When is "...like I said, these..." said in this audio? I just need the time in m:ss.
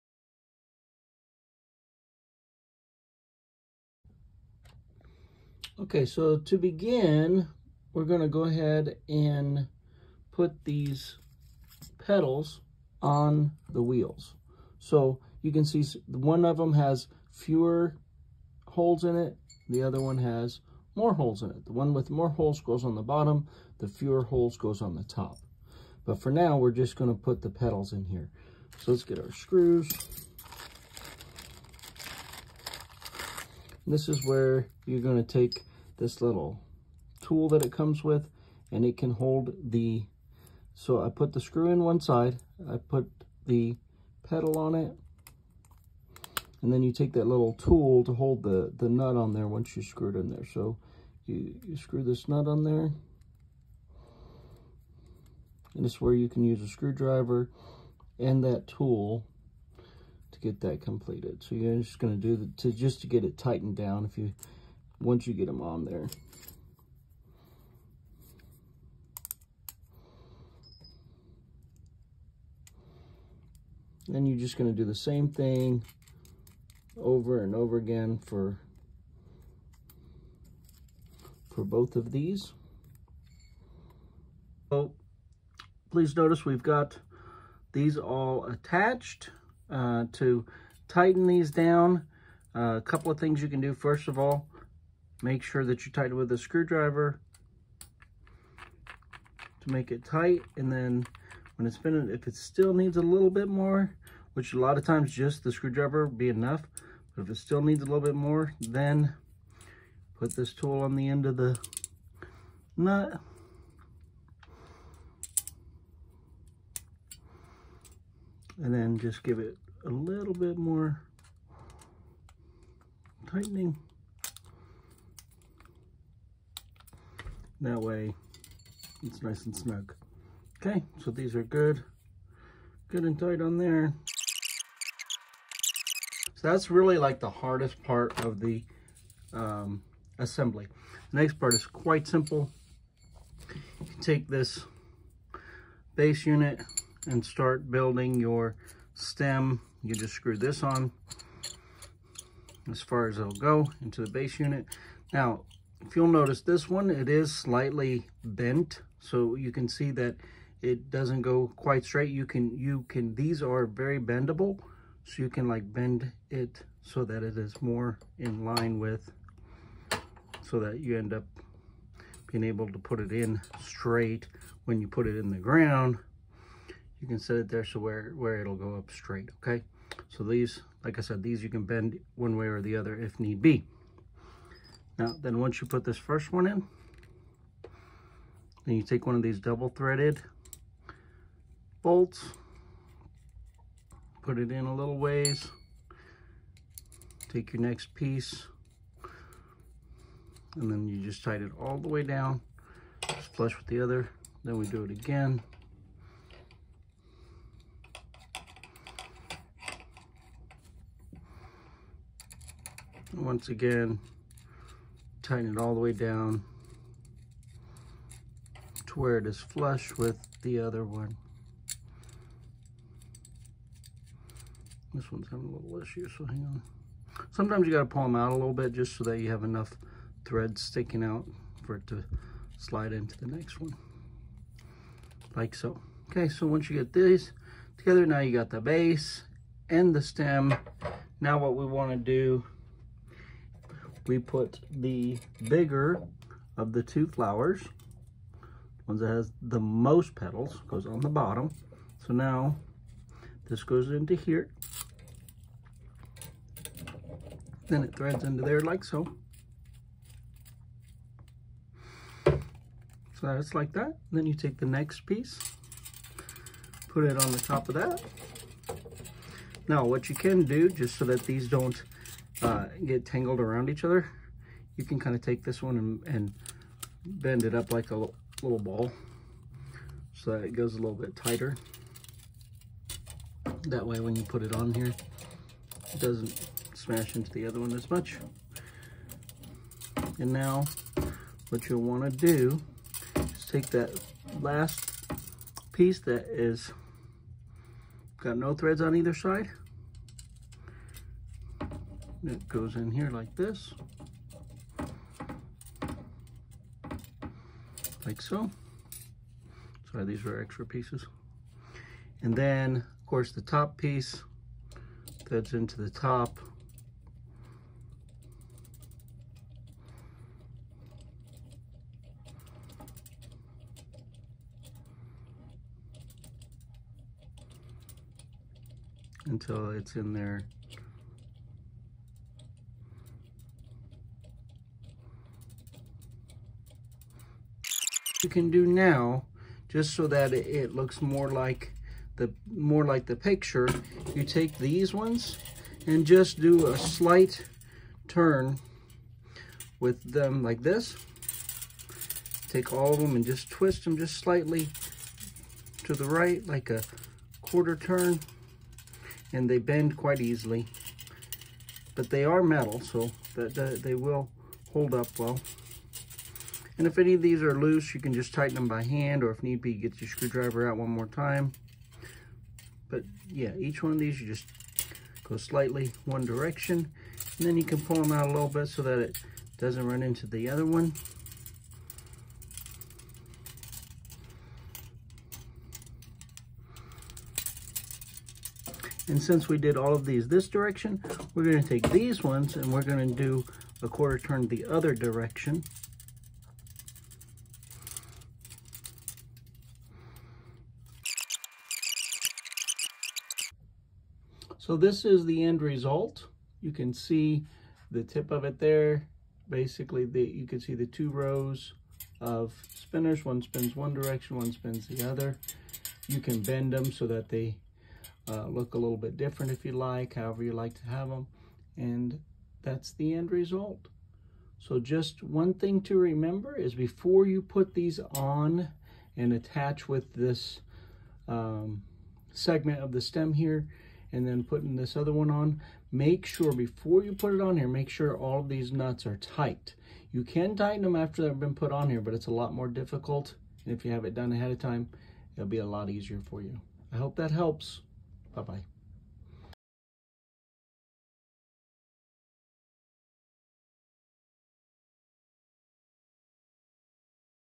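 3:00.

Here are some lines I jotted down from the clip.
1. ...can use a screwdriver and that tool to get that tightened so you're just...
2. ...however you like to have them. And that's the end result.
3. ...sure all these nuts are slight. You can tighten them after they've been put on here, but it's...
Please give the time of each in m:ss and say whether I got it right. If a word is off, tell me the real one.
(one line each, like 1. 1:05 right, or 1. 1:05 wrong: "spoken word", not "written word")
1. 0:56 wrong: "completed", not "tightened"
2. 7:00 right
3. 7:17 wrong: "tight", not "slight".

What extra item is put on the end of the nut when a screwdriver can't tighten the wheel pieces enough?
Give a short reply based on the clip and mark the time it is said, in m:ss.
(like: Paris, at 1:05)
this tool, at 1:50.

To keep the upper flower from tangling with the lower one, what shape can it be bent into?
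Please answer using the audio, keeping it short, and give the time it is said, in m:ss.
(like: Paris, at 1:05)
a little ball, at 4:37.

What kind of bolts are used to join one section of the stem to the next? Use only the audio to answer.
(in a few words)
double threaded bolts.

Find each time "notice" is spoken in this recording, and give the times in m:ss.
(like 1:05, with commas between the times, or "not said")
1:26, 2:36.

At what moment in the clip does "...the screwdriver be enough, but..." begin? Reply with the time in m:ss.
1:45.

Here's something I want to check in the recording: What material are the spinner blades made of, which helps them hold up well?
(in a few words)
metal.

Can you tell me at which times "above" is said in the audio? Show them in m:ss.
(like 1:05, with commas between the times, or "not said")
not said.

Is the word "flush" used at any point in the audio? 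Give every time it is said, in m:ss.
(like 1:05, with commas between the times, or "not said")
3:23, 3:39.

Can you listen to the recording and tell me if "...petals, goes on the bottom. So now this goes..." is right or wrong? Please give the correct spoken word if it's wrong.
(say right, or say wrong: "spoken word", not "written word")
right.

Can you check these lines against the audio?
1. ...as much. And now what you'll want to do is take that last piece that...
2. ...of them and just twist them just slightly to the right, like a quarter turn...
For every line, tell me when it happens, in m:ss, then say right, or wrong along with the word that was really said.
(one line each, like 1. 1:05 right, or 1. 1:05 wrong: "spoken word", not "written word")
1. 4:47 right
2. 5:52 right.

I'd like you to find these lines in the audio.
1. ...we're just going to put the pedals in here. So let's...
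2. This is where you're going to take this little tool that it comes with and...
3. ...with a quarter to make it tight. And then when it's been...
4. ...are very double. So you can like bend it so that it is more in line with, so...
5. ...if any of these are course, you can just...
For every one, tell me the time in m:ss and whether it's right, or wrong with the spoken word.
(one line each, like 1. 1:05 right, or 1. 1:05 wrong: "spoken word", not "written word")
1. 0:26 right
2. 0:33 right
3. 1:36 wrong: "screwdriver", not "quarter"
4. 2:43 wrong: "bendable", not "double"
5. 6:06 wrong: "loose", not "course".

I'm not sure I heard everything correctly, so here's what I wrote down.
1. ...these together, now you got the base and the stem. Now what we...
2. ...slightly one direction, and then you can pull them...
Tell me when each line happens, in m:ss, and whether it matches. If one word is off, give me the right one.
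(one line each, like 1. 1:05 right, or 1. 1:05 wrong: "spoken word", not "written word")
1. 3:56 right
2. 6:15 right.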